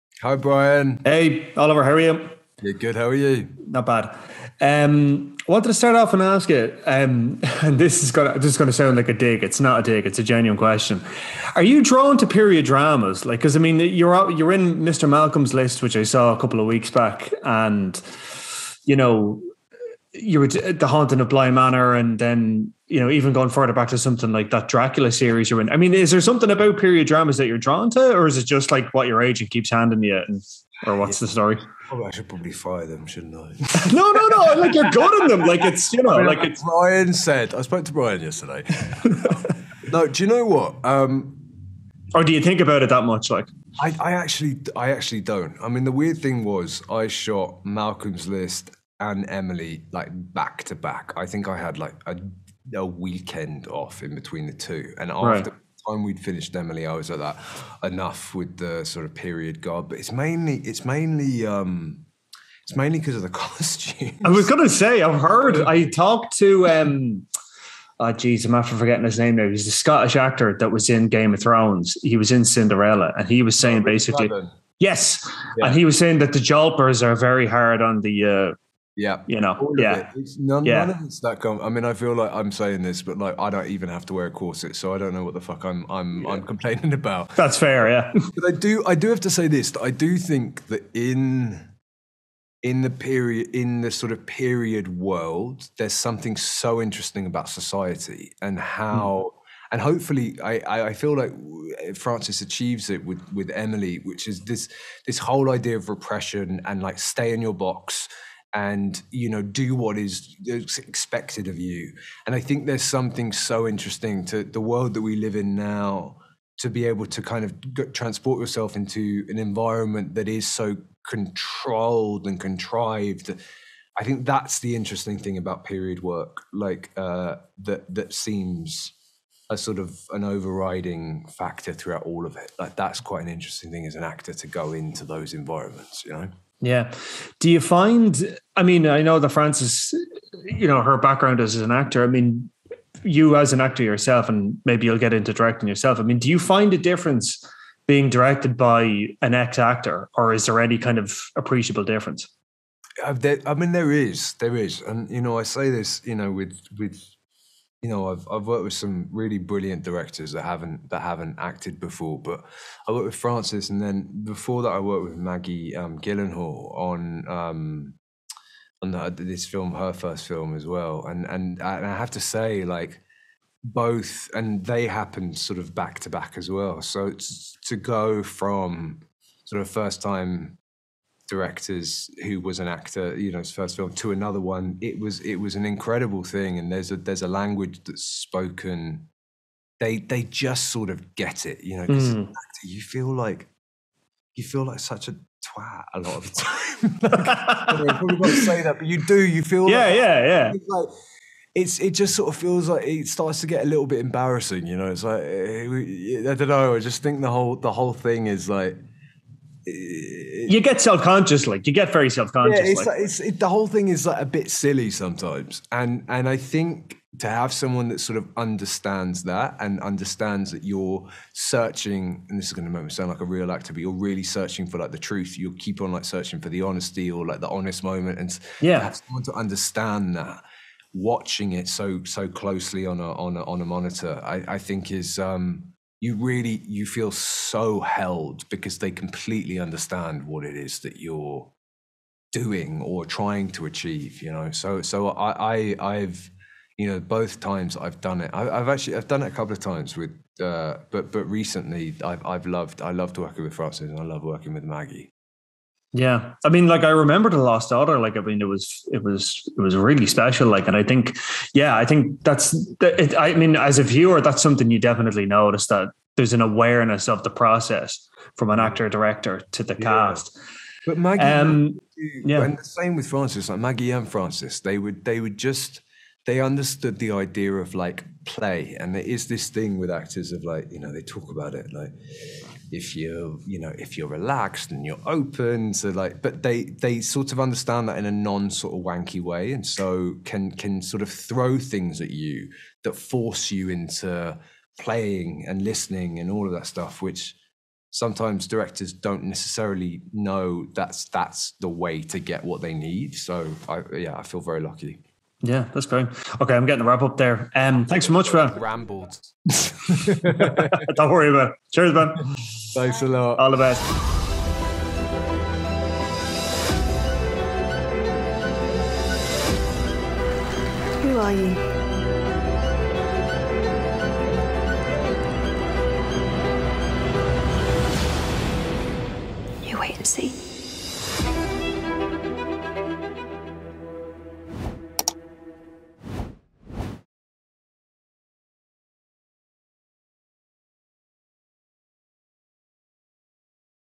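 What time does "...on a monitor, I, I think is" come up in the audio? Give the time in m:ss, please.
3:53.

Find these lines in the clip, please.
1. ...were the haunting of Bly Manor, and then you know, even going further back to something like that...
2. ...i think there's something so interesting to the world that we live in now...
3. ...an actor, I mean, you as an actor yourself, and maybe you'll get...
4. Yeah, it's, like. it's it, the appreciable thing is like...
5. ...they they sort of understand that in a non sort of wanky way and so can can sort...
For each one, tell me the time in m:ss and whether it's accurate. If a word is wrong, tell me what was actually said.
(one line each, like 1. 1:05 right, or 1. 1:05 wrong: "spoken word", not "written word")
1. 0:20 right
2. 1:52 right
3. 2:21 right
4. 3:32 wrong: "whole", not "appreciable"
5. 4:46 right.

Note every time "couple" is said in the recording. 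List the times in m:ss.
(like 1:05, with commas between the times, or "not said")
0:16, 4:09.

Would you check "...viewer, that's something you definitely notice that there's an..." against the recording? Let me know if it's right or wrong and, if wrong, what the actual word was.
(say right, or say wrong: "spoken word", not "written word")
right.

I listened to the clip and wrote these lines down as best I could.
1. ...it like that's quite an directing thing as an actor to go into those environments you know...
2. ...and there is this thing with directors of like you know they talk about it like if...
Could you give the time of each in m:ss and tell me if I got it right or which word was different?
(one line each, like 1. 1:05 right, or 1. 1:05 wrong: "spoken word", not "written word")
1. 2:12 wrong: "interesting", not "directing"
2. 4:38 wrong: "actors", not "directors".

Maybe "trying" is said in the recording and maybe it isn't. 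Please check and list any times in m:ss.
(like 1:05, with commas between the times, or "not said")
4:03.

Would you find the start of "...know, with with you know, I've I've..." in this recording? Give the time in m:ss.
2:36.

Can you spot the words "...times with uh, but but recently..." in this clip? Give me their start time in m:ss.
4:09.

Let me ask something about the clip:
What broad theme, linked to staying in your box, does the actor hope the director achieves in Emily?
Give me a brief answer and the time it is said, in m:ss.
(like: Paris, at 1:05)
Repression, at 1:45.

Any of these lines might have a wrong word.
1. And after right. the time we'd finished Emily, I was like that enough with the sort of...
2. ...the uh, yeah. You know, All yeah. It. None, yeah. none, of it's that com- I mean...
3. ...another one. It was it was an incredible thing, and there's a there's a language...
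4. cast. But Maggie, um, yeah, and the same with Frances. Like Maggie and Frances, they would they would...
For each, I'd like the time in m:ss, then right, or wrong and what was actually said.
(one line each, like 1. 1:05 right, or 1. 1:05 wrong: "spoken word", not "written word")
1. 0:54 right
2. 1:18 right
3. 3:04 right
4. 4:29 right.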